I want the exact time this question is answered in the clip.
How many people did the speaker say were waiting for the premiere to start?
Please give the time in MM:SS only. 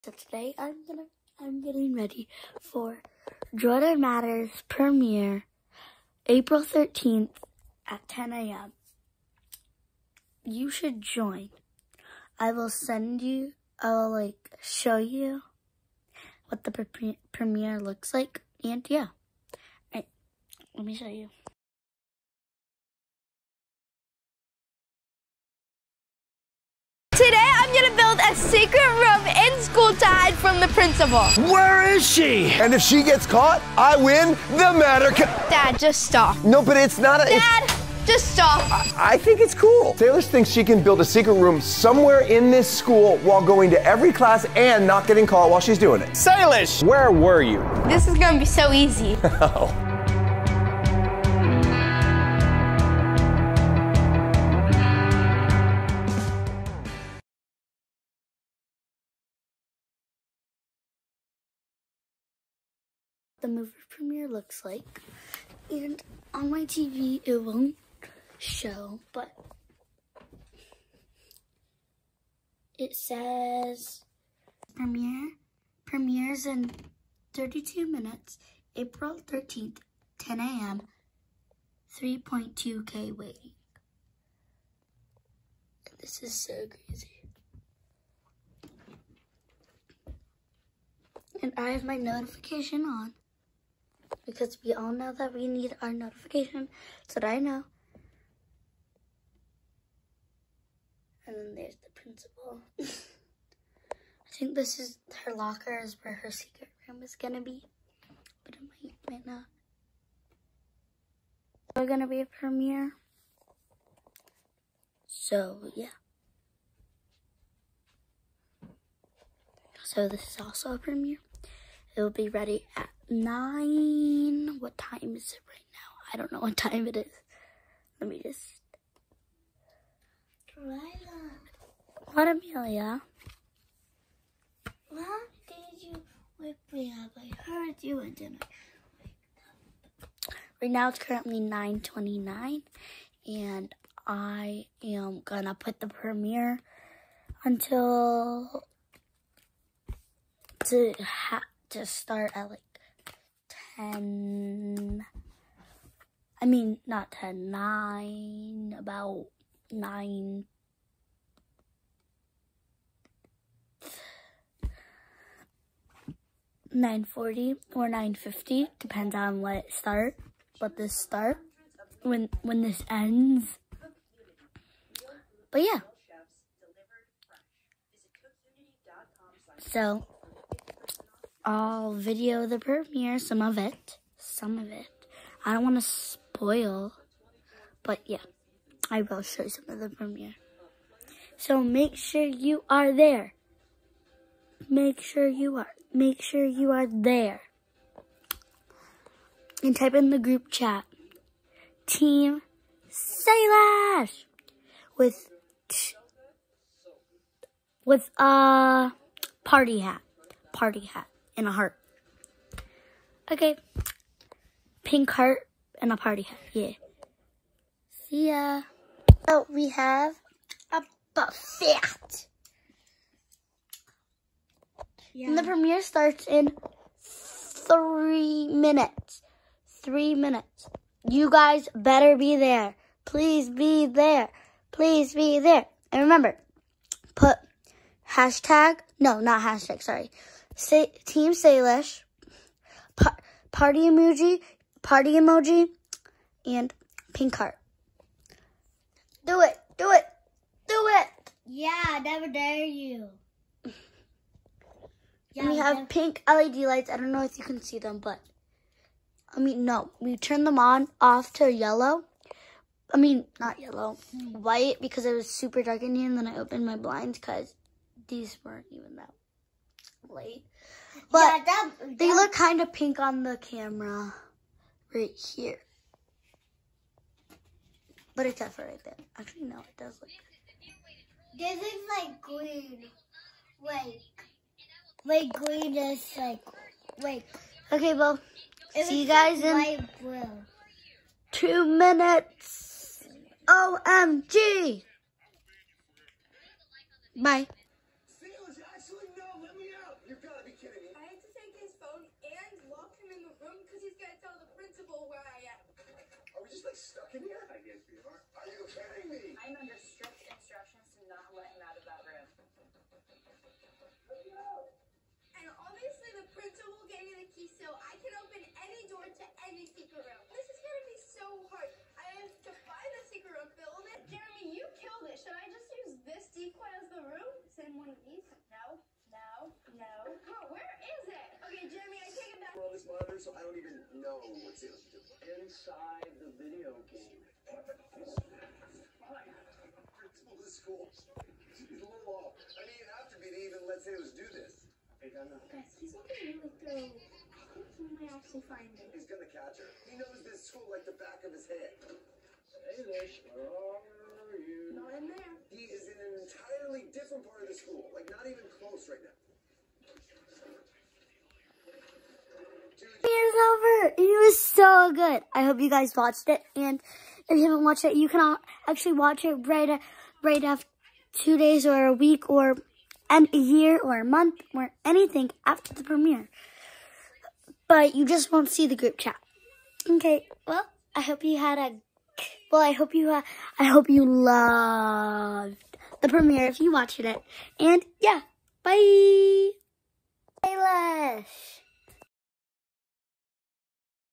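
01:21.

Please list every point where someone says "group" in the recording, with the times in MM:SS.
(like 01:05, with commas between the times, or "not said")
03:20, 06:18.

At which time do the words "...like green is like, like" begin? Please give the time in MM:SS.
04:45.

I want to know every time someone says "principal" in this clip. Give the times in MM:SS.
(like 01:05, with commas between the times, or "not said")
00:30, 01:41, 05:37.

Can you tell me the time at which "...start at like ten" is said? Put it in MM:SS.
02:31.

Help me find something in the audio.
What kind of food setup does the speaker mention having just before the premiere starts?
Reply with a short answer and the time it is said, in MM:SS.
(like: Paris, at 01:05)
A buffet, at 03:41.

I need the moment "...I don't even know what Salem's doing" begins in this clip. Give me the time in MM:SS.
05:33.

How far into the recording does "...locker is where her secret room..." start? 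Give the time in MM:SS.
01:45.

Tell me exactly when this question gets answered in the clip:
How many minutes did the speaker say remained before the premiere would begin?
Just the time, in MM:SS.
01:17.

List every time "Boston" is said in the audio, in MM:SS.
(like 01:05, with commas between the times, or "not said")
not said.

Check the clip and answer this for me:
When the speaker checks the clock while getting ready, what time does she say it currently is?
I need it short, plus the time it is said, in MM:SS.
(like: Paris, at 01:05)
9:29, at 02:21.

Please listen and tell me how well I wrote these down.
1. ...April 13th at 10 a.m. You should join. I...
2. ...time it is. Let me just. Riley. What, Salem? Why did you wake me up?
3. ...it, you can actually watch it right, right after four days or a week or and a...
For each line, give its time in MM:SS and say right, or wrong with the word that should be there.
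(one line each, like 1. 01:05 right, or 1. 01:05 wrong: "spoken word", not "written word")
1. 00:06 right
2. 02:06 wrong: "Amelia", not "Salem"
3. 06:07 wrong: "two", not "four".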